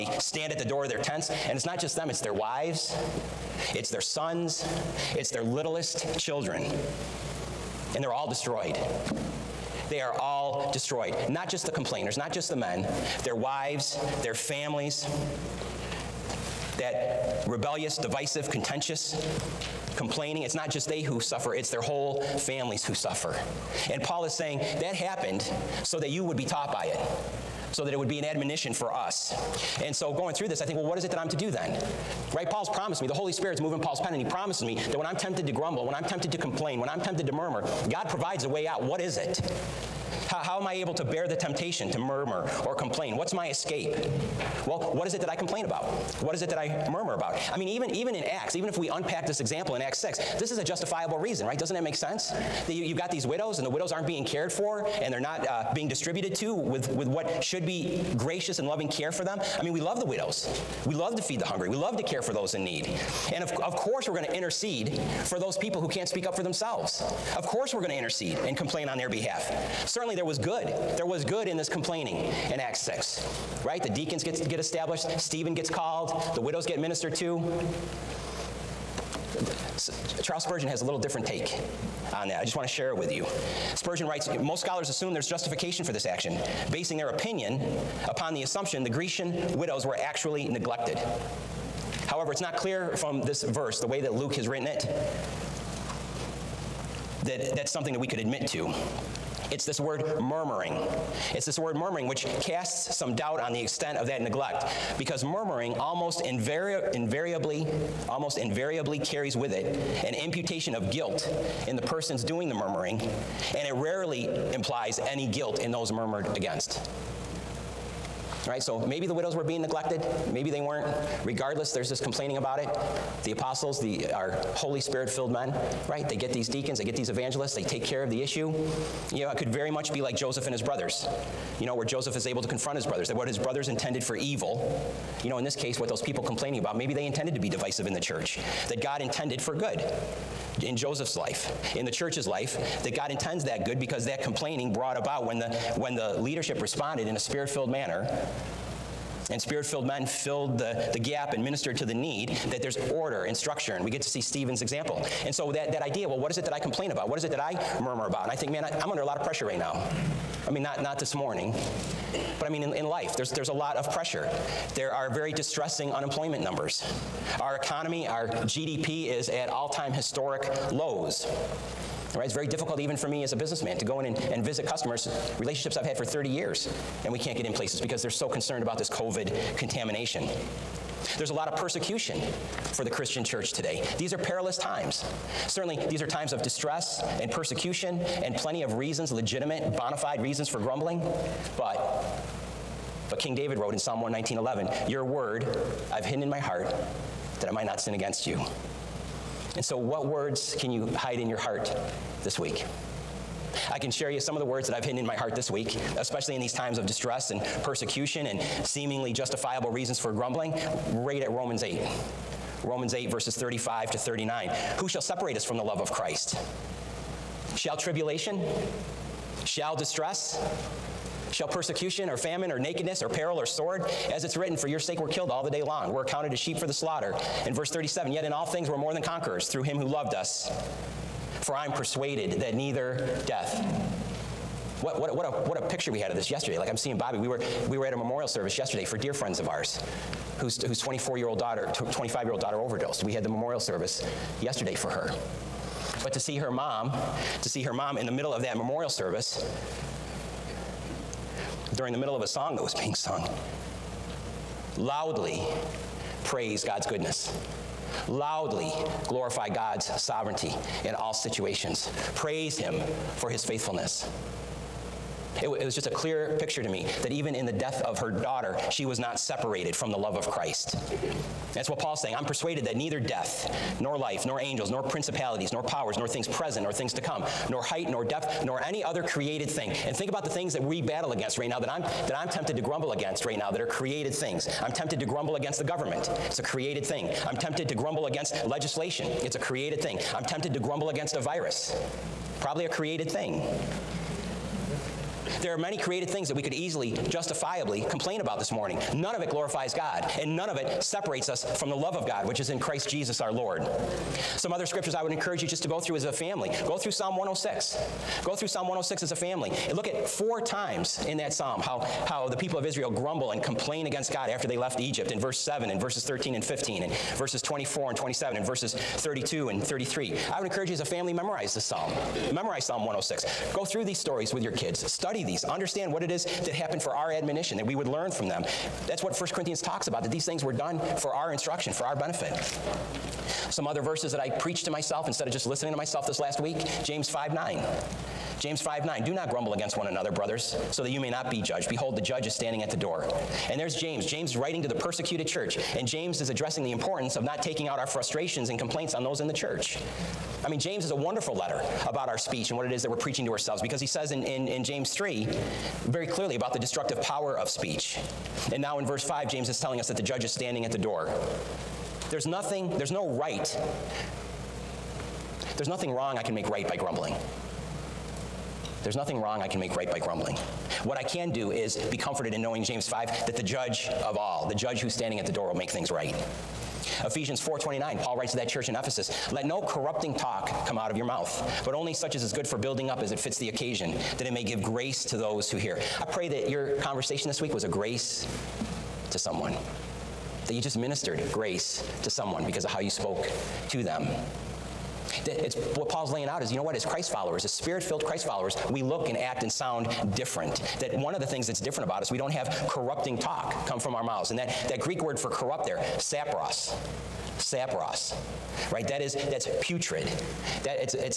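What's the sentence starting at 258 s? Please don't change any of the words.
Loudly glorify God's sovereignty in all situations.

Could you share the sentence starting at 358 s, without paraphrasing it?
And now in verse 5, James is telling us that the judge is standing at the door.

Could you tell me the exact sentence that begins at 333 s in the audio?
Some other verses that I preached to myself instead of just listening to myself this last week James 5 9.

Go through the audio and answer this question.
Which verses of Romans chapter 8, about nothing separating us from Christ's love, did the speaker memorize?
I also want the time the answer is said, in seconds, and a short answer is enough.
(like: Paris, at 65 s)
35 to 39, at 213 s.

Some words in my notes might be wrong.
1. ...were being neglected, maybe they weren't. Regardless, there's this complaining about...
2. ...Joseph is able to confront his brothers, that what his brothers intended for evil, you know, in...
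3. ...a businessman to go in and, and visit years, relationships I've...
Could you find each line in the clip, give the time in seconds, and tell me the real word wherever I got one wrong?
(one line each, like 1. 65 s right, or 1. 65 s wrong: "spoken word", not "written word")
1. 119 s right
2. 131 s right
3. 173 s wrong: "customers", not "years".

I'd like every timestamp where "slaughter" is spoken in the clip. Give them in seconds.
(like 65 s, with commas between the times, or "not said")
226 s.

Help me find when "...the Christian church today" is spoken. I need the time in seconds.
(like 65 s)
182 s.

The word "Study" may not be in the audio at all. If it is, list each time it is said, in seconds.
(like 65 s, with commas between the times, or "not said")
324 s.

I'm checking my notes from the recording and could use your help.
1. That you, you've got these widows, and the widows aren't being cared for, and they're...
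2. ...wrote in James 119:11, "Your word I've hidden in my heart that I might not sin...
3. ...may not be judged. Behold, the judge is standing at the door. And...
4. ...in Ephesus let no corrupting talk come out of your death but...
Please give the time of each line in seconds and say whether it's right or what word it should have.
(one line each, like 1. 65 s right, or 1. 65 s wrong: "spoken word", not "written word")
1. 52 s right
2. 193 s wrong: "Psalm", not "James"
3. 340 s right
4. 378 s wrong: "mouth", not "death".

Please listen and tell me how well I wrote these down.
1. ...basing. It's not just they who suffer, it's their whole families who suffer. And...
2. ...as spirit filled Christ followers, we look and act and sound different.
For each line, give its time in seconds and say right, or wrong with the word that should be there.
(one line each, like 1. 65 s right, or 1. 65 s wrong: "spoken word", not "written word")
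1. 19 s wrong: "complaining", not "basing"
2. 397 s right.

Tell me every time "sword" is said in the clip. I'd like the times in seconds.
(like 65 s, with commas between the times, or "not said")
223 s.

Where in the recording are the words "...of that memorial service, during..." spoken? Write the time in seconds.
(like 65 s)
248 s.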